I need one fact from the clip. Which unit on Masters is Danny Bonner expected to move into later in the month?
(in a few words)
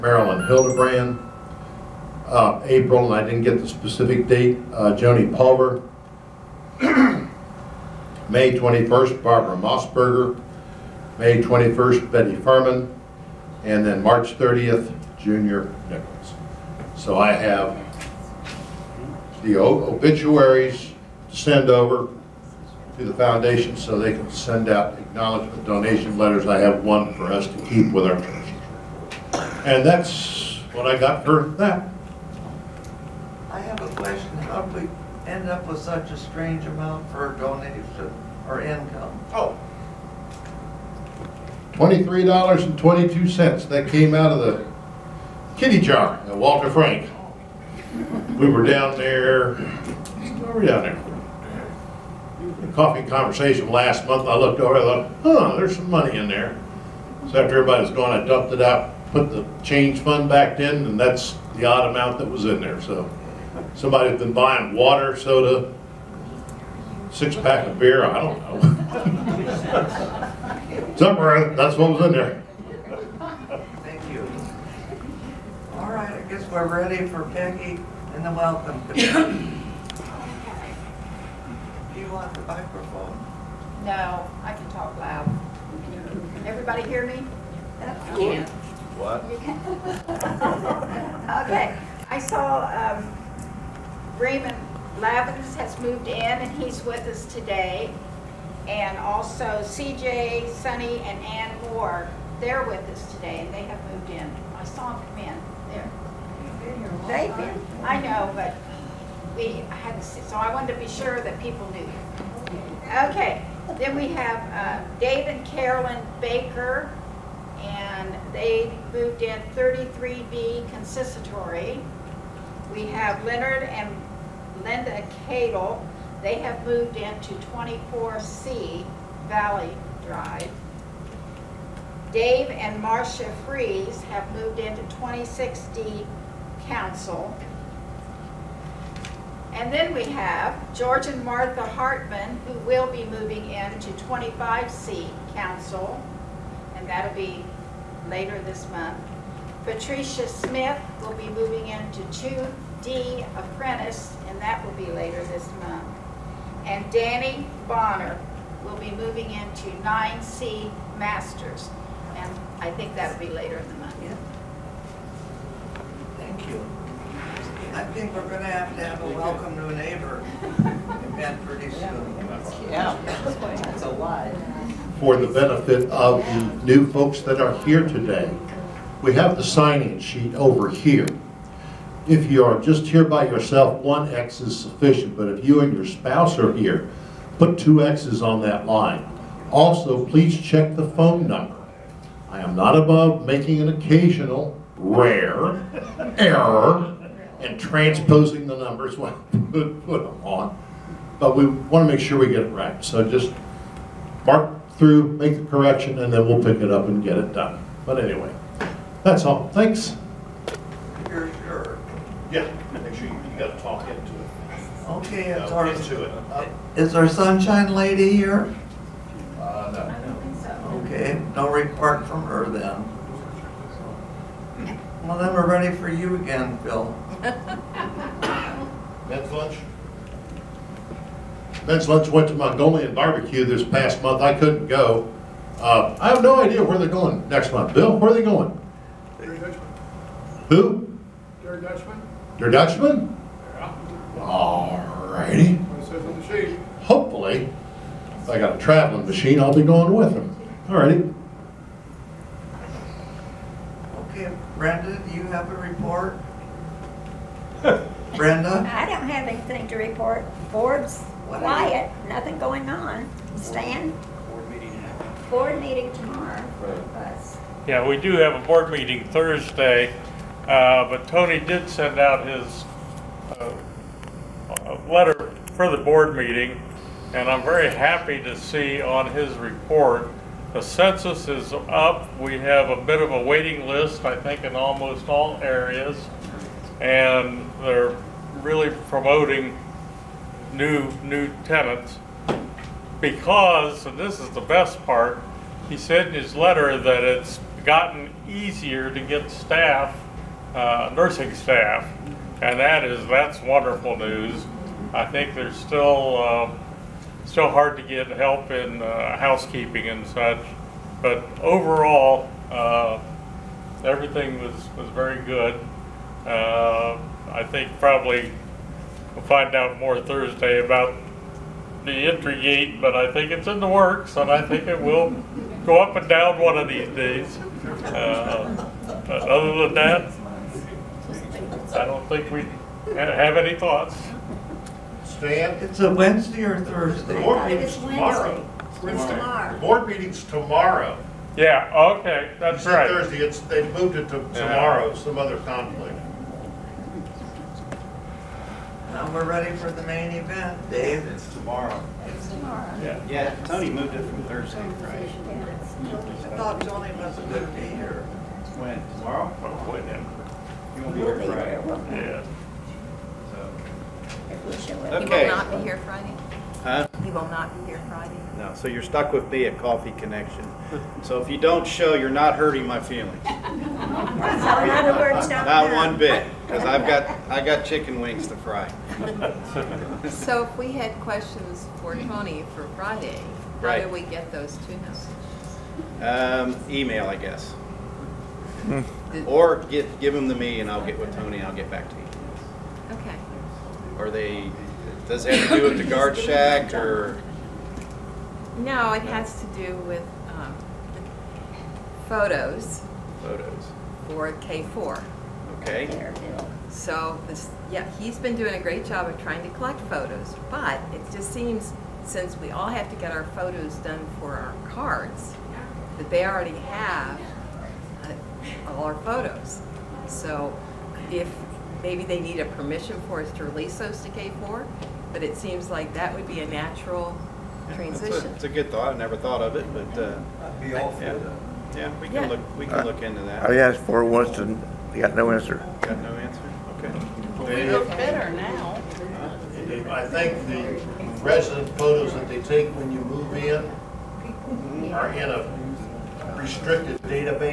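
9C.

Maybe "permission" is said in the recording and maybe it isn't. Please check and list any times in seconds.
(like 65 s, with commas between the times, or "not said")
422 s.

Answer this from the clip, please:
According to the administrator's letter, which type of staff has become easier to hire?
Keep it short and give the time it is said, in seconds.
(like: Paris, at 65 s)
Nursing staff, at 300 s.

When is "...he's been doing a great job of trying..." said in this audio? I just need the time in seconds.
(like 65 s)
407 s.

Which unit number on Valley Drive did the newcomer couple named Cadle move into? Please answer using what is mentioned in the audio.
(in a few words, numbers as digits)
24C.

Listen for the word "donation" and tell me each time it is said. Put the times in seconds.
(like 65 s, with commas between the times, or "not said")
25 s, 37 s.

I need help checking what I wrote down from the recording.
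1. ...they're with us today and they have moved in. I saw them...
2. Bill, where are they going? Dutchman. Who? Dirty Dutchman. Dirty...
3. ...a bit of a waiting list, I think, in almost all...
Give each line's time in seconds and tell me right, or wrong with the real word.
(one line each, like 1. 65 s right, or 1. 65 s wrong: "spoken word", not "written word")
1. 102 s right
2. 237 s right
3. 282 s right.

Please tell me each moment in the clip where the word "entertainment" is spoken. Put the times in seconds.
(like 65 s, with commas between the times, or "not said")
not said.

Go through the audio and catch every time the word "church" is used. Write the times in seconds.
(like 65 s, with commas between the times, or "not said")
28 s.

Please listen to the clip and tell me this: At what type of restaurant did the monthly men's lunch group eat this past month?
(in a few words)
Mongolian barbecue.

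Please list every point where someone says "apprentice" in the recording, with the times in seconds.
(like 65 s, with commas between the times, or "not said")
153 s.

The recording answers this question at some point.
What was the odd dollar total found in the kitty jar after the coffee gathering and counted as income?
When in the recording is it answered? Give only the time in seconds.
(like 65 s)
41 s.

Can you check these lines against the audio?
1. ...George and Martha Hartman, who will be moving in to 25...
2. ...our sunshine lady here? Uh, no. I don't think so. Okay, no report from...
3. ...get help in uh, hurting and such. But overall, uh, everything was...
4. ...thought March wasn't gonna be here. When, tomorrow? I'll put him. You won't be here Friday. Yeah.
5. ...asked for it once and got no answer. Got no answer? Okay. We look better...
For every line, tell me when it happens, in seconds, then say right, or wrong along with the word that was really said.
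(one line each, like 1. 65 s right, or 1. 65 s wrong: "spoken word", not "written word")
1. 140 s right
2. 216 s right
3. 307 s wrong: "housekeeping", not "hurting"
4. 356 s wrong: "Tony", not "March"
5. 433 s right.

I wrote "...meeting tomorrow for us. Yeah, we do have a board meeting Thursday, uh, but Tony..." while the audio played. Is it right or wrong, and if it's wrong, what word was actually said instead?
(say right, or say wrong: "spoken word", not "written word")
right.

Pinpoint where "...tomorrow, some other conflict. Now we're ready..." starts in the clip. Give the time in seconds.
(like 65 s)
344 s.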